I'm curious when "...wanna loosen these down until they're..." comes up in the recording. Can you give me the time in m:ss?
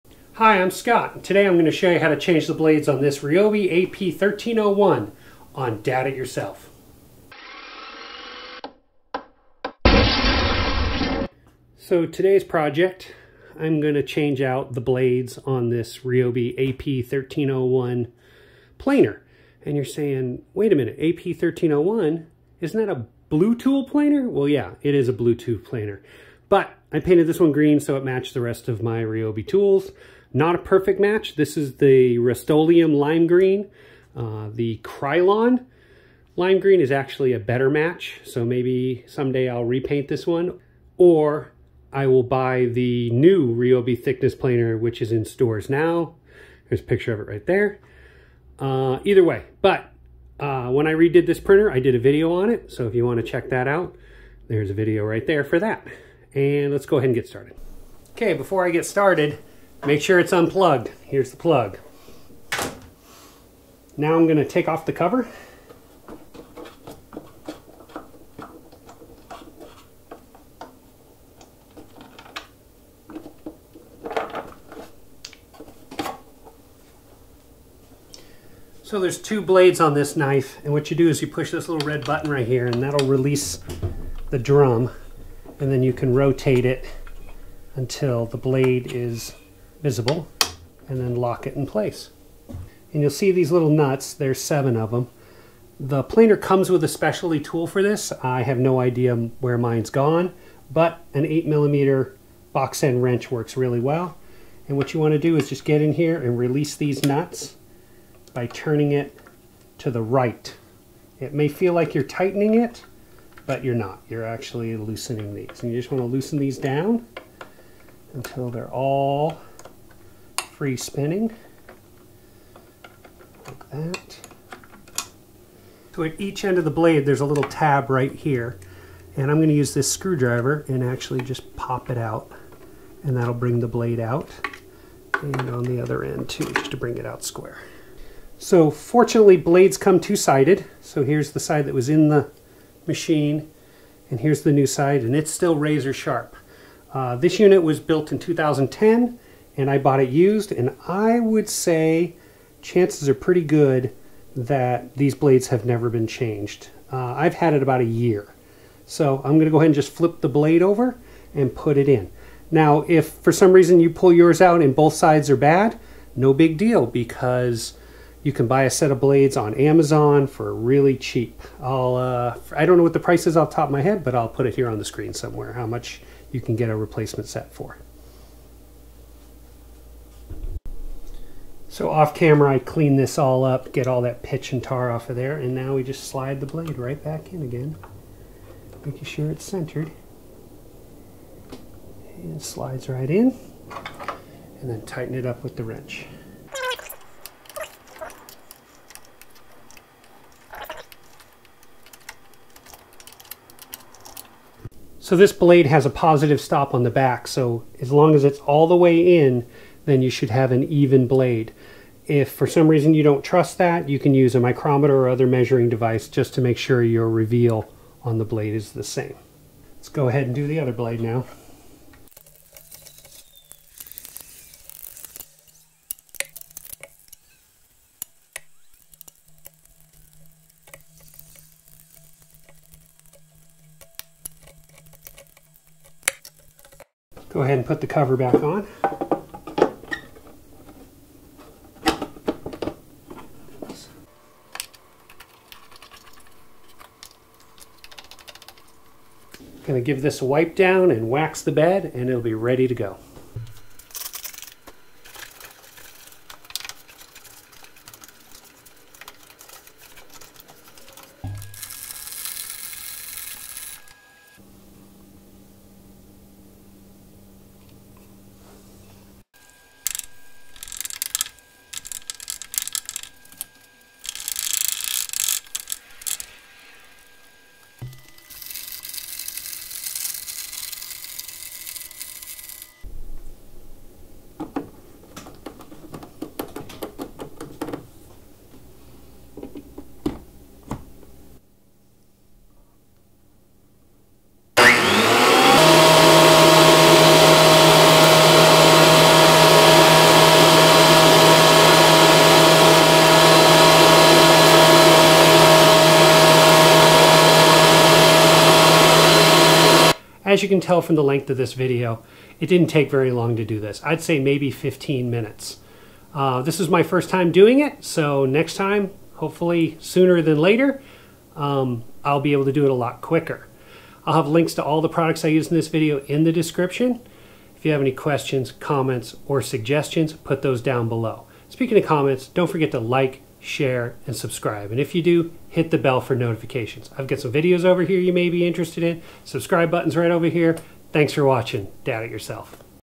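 1:55.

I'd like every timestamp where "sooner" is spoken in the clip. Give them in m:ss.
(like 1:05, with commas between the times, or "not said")
5:19.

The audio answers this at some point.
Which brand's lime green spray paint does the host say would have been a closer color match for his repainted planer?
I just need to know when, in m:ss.
0:34.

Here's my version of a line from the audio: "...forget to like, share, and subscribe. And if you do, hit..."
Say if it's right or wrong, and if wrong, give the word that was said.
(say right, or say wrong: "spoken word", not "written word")
right.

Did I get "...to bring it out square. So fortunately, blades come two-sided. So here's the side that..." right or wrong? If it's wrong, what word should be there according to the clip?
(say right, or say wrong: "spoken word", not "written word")
right.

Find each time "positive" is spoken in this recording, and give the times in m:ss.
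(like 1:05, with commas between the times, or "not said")
3:25.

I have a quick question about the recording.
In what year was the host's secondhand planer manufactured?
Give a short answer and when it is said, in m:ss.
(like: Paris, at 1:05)
2010, at 2:28.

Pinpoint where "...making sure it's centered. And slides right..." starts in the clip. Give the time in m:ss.
3:08.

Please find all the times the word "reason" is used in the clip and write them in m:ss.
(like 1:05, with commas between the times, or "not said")
2:43, 3:32.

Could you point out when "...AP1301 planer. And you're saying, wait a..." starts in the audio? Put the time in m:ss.
0:16.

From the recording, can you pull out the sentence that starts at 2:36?
Uh, I've had it about a year.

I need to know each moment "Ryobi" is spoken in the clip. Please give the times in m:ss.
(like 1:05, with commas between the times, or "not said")
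0:03, 0:15, 0:29, 0:43.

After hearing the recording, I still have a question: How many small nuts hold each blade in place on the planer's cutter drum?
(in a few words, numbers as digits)
7.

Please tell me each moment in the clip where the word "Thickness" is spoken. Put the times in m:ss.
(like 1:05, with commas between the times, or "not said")
0:44.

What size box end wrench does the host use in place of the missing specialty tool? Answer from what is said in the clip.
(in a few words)
8 millimeter.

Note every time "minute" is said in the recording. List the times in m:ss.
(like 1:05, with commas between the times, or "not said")
0:20, 5:15.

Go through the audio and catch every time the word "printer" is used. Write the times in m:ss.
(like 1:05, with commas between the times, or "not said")
0:51.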